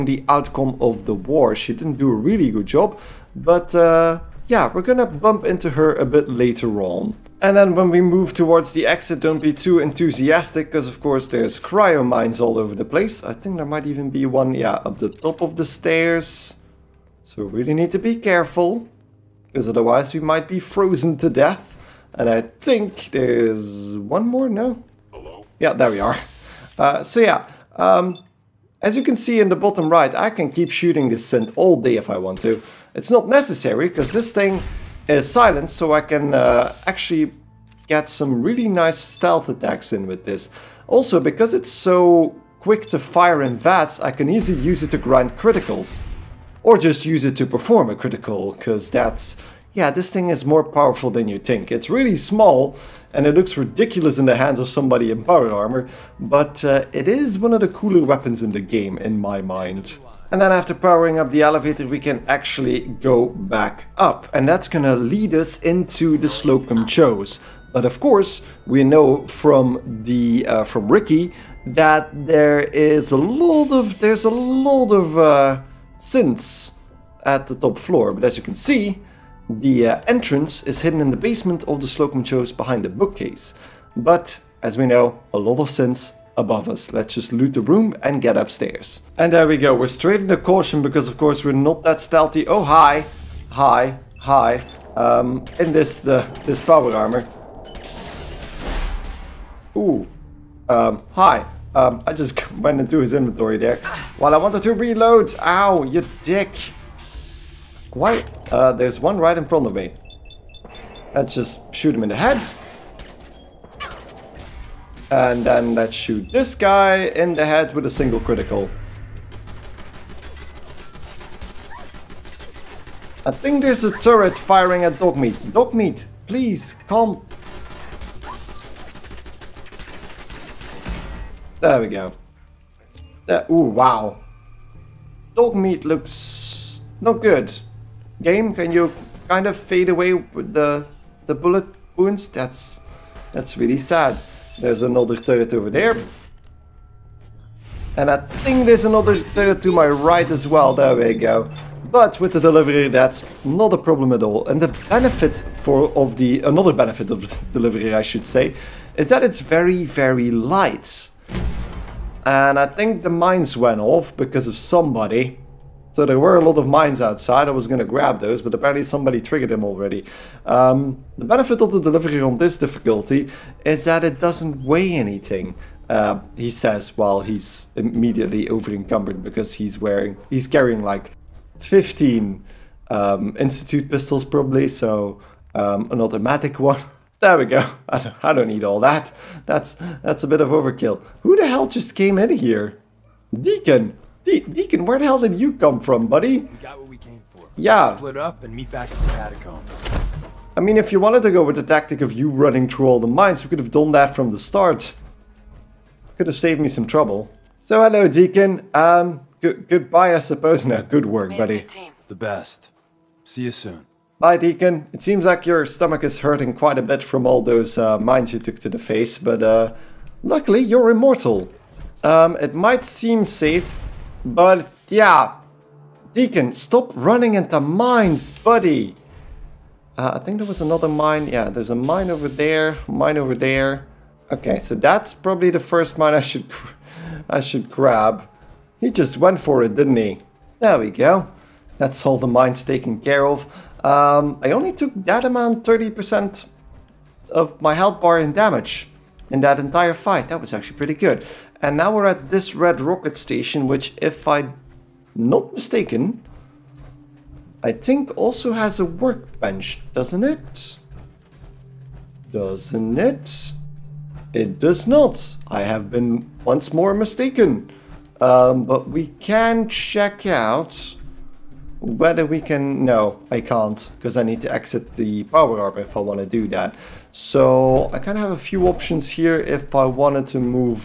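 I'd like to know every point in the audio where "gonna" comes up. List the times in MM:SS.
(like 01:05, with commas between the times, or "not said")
00:04, 01:04.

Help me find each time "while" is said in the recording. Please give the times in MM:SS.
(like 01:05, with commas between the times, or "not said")
01:44, 02:56.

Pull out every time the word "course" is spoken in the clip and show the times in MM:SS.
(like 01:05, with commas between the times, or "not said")
00:10, 01:07, 01:31.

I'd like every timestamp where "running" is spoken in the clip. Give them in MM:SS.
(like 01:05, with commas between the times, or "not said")
03:22, 03:46.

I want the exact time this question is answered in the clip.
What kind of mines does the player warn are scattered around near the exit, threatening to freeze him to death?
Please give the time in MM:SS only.
00:11.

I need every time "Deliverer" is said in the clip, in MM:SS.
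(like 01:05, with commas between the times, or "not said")
02:32, 02:37, 02:51.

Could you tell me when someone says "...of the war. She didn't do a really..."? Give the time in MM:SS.
00:00.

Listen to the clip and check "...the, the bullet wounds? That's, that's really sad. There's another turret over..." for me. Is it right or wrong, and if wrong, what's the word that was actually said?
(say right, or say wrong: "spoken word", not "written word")
right.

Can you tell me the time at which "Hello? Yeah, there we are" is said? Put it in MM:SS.
00:25.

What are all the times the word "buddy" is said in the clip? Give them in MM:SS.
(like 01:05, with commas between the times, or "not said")
03:16, 03:31, 03:48.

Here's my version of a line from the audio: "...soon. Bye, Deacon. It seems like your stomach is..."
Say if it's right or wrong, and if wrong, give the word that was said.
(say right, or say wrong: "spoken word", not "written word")
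right.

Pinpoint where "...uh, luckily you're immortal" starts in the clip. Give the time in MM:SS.
03:39.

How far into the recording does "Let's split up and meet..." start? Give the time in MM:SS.
03:17.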